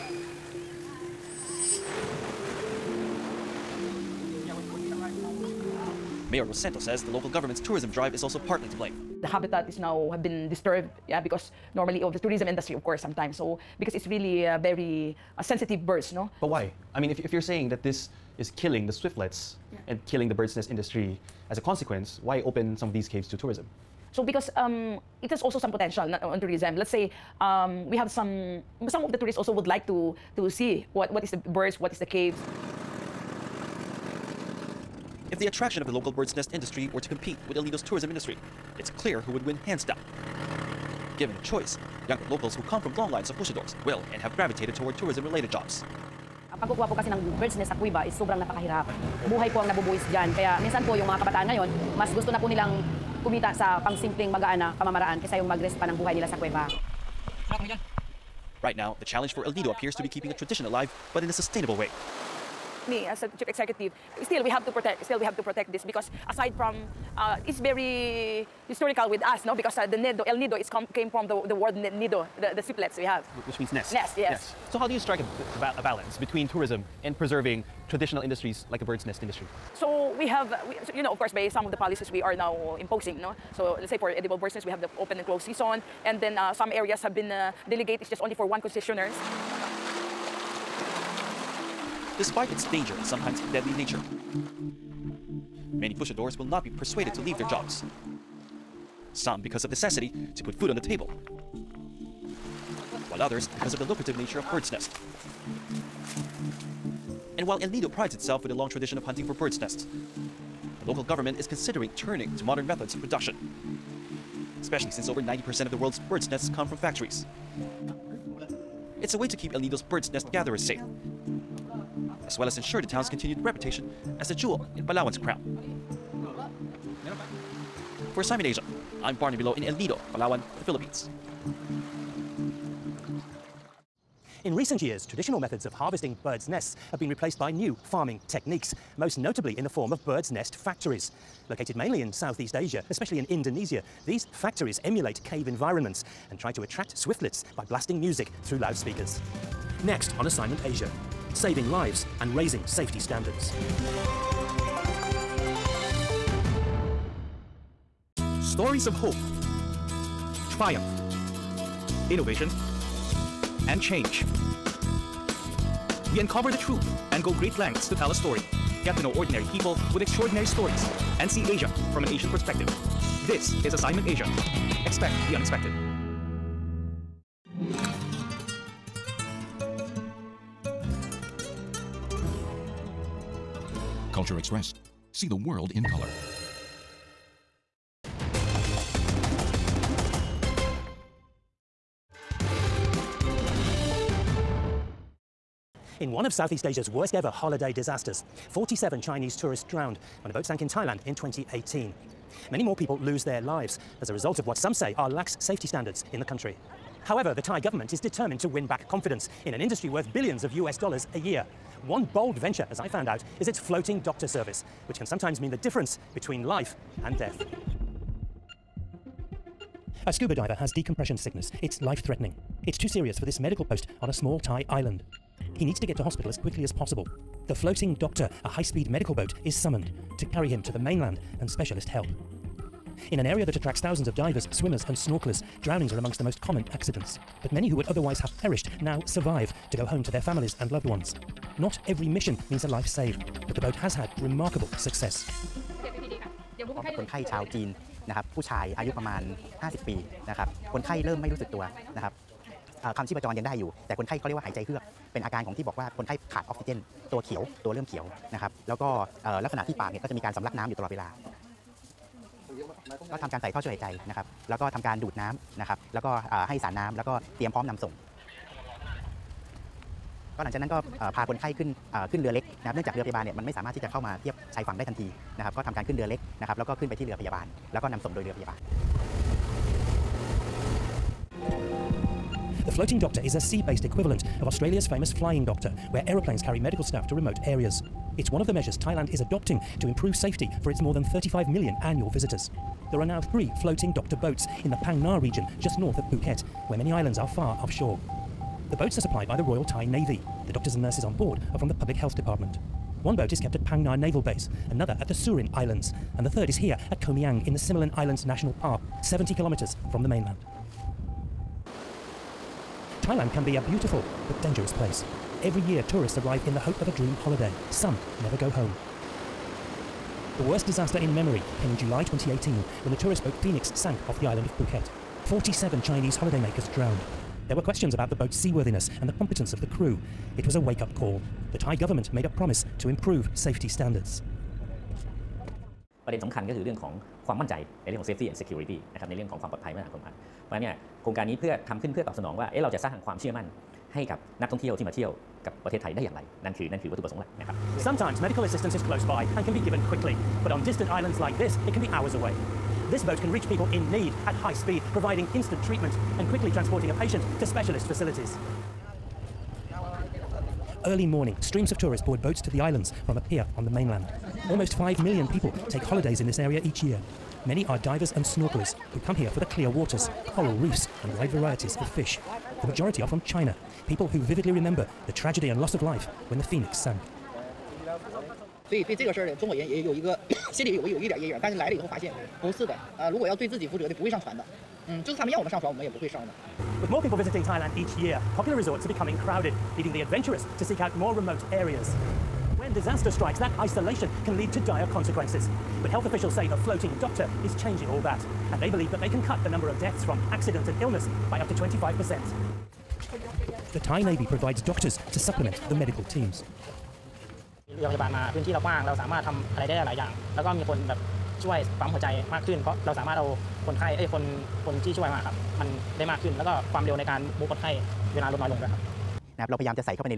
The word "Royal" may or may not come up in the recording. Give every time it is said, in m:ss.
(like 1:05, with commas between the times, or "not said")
4:59.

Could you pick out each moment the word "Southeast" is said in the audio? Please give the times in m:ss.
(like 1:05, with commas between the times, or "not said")
2:22, 3:16.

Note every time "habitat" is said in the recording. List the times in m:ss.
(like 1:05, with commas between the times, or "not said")
0:09.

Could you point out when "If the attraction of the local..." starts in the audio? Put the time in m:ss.
0:35.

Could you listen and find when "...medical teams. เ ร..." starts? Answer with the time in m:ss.
6:45.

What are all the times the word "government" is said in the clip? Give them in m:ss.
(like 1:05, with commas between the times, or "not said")
0:07, 1:51, 3:27, 5:31.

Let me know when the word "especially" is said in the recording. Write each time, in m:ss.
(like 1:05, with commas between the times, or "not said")
1:54, 2:22.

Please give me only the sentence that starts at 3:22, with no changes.
Many more people lose their lives as a result of what some say are lax safety standards in the country.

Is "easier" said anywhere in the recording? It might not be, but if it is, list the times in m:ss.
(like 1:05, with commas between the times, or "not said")
not said.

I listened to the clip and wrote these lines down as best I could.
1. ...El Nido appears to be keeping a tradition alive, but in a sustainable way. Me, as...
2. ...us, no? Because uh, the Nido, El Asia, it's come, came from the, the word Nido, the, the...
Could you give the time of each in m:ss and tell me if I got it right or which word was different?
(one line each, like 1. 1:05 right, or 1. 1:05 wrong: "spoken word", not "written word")
1. 0:59 right
2. 1:09 wrong: "Nido", not "Asia".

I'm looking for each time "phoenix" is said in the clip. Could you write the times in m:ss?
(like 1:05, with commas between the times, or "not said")
5:23, 6:16.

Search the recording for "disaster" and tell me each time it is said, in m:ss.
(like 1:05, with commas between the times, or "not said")
3:17, 5:20, 6:32.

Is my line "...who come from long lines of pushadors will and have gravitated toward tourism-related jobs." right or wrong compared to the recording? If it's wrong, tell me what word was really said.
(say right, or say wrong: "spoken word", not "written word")
right.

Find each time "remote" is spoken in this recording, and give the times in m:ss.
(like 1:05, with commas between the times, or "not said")
4:47, 6:31.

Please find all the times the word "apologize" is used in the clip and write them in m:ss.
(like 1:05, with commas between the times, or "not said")
not said.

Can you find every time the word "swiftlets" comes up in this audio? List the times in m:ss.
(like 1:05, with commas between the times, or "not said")
0:18, 2:26.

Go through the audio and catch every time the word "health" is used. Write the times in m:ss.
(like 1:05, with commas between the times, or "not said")
5:01, 6:35.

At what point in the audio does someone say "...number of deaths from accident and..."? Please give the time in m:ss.
6:39.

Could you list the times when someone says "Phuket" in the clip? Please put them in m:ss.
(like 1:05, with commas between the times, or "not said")
4:56, 5:24.